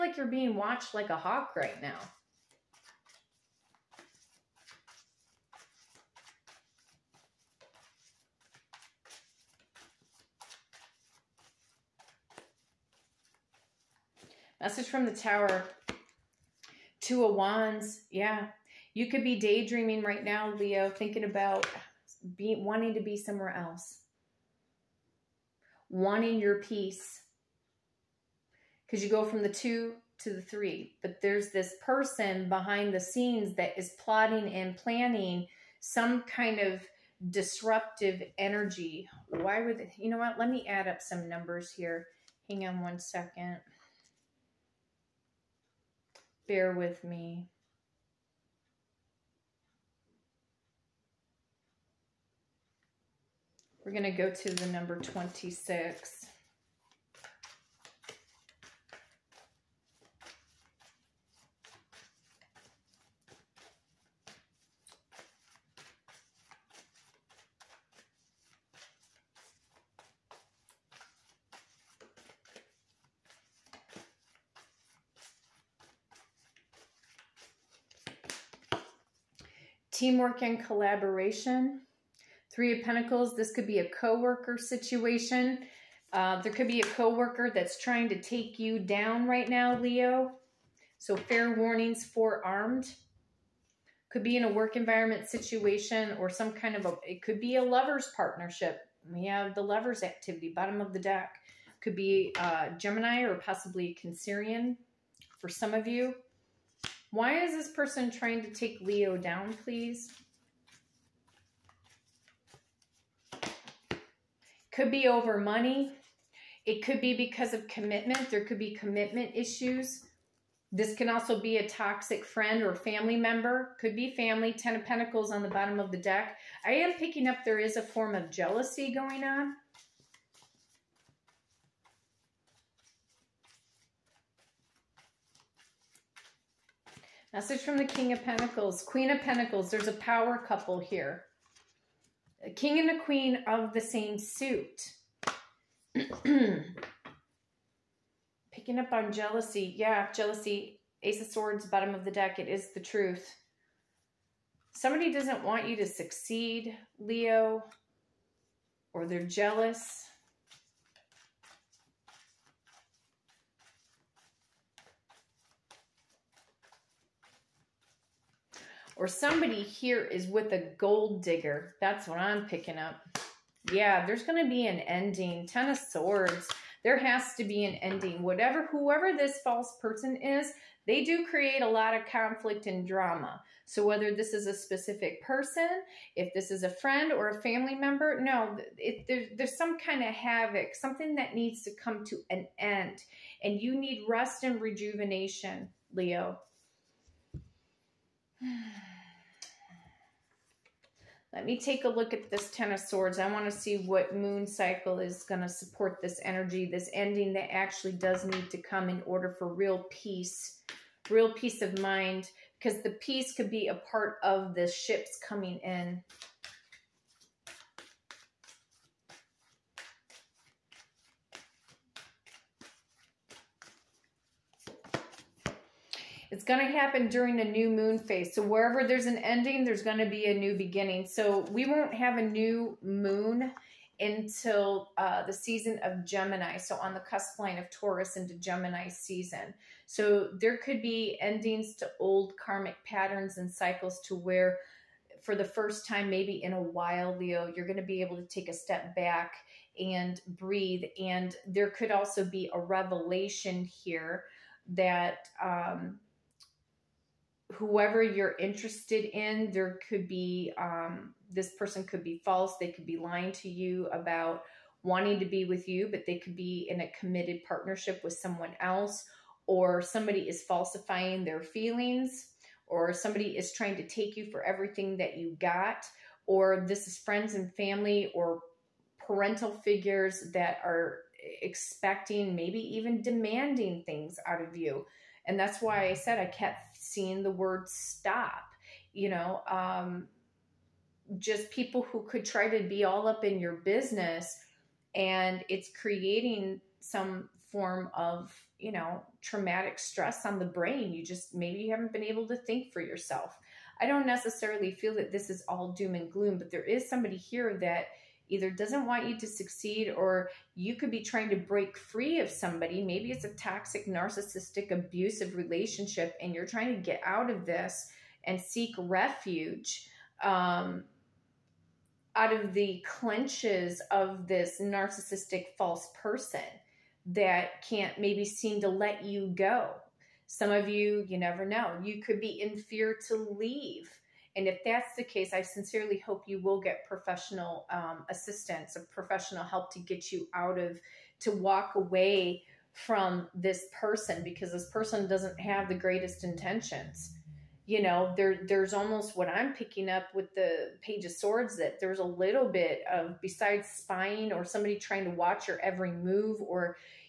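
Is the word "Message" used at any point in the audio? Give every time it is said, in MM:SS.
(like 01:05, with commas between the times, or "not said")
00:14, 02:17.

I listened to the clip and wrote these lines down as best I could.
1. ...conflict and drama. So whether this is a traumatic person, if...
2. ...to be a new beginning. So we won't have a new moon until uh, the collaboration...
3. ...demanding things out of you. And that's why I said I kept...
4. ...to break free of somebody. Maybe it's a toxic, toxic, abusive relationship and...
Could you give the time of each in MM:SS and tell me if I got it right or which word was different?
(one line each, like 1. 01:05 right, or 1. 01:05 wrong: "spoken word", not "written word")
1. 03:02 wrong: "specific", not "traumatic"
2. 03:49 wrong: "season", not "collaboration"
3. 04:43 right
4. 05:11 wrong: "narcissistic", not "toxic".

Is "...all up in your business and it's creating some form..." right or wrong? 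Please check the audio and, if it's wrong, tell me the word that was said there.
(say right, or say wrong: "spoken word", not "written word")
right.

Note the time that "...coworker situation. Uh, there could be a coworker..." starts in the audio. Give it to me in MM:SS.
01:23.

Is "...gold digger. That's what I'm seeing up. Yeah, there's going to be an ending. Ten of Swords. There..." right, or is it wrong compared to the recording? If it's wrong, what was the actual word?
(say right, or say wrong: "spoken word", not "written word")
wrong: "picking", not "seeing".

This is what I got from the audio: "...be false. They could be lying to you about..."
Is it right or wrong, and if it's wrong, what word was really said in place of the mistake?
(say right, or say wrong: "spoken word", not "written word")
right.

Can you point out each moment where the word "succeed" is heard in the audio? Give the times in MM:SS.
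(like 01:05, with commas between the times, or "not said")
02:35, 05:09.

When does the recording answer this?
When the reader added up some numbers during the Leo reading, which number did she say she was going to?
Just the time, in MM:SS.
00:54.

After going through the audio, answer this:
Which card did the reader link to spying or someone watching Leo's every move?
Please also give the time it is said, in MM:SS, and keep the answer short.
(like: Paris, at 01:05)
Page of Swords, at 05:50.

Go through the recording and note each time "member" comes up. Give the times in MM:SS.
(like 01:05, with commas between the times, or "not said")
02:03, 03:07.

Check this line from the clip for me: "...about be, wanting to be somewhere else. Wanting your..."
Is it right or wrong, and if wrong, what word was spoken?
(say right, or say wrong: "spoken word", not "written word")
right.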